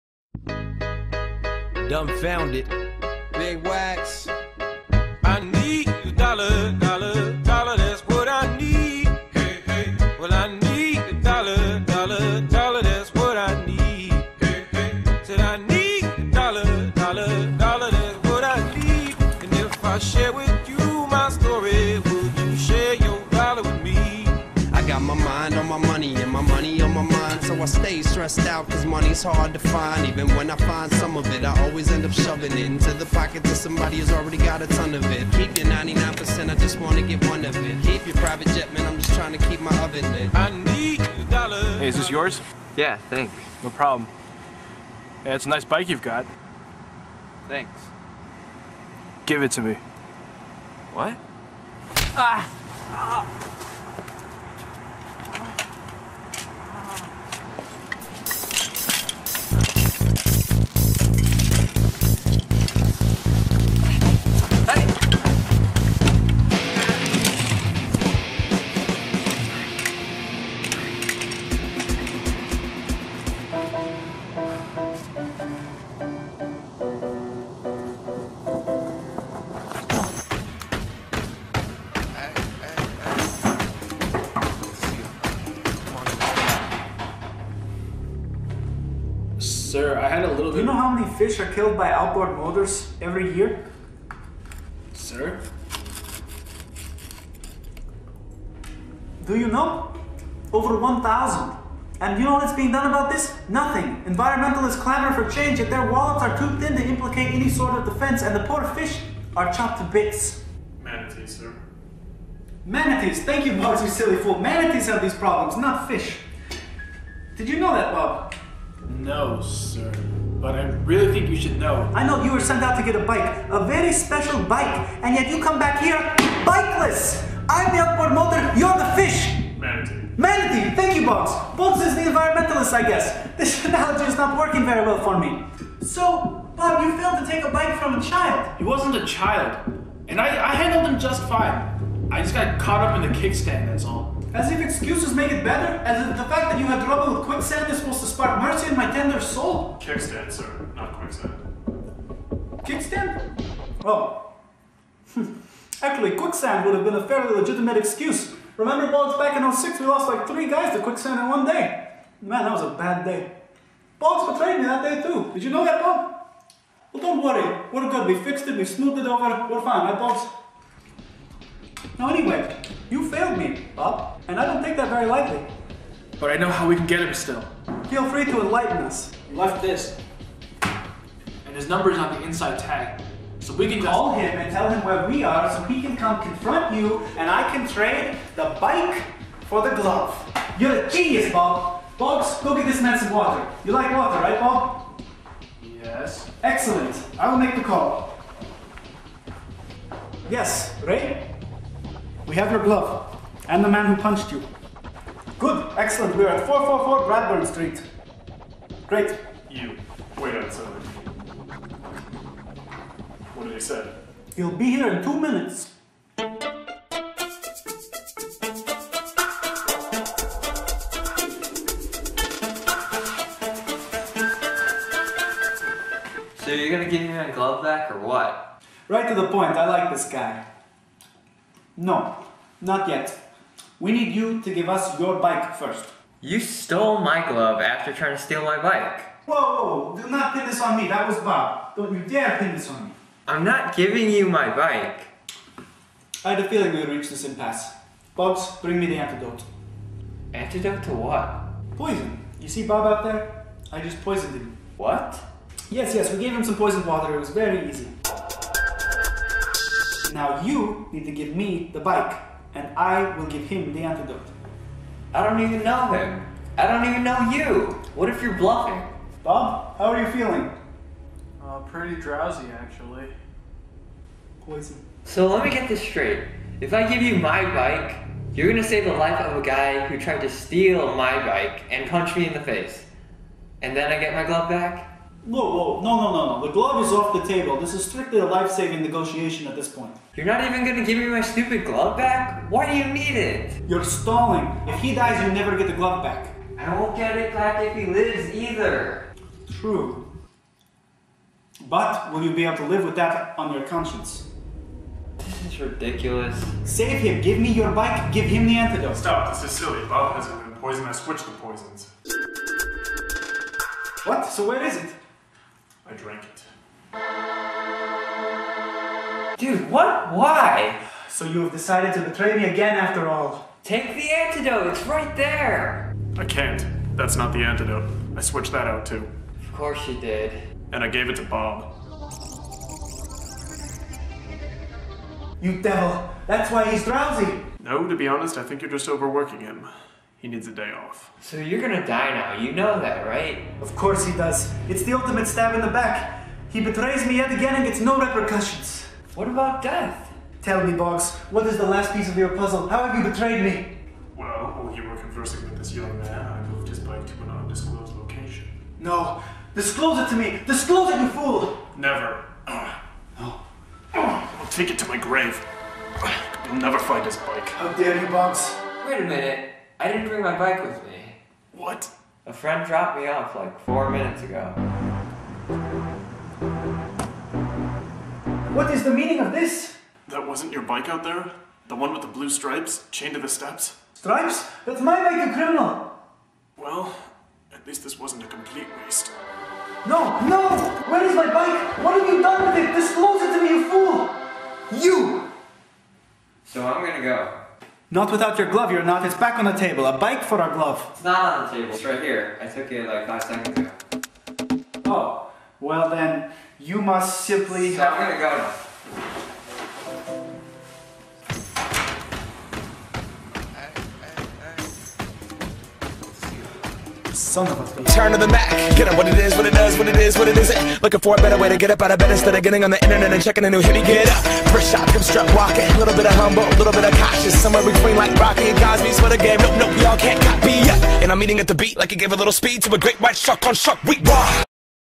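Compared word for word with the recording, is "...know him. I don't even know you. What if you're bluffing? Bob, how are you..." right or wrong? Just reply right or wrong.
right.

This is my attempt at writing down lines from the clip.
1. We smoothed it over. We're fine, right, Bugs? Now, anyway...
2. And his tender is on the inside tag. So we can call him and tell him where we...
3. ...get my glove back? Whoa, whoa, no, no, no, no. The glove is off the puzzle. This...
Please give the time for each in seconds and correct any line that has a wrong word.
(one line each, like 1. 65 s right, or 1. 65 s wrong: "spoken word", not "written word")
1. 168 s right
2. 180 s wrong: "number", not "tender"
3. 283 s wrong: "table", not "puzzle".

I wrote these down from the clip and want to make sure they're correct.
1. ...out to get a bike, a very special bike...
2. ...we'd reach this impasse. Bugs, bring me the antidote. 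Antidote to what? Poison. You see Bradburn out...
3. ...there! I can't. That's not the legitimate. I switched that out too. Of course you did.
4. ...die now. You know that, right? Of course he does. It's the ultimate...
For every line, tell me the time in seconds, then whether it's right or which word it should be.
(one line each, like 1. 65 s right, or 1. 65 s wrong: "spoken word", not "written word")
1. 122 s right
2. 246 s wrong: "Bob", not "Bradburn"
3. 325 s wrong: "antidote", not "legitimate"
4. 341 s right.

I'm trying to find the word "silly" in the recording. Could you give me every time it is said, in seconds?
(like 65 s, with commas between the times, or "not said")
113 s, 309 s.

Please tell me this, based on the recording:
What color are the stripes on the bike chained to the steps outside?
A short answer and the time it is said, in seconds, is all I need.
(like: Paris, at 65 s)
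Blue, at 382 s.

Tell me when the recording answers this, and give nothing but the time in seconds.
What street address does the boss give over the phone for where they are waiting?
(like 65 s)
206 s.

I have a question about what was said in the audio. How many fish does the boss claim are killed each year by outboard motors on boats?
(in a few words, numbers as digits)
Over 1,000.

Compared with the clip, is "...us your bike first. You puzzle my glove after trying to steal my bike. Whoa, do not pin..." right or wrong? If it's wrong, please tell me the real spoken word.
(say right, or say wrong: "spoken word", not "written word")
wrong: "stole", not "puzzle".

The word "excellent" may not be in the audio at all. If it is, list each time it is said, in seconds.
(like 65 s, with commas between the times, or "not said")
196 s, 205 s.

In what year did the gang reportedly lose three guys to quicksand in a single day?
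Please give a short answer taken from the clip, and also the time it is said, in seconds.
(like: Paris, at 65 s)
2006, at 159 s.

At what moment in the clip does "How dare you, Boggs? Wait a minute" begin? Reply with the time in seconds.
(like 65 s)
367 s.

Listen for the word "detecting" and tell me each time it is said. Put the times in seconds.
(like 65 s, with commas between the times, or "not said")
not said.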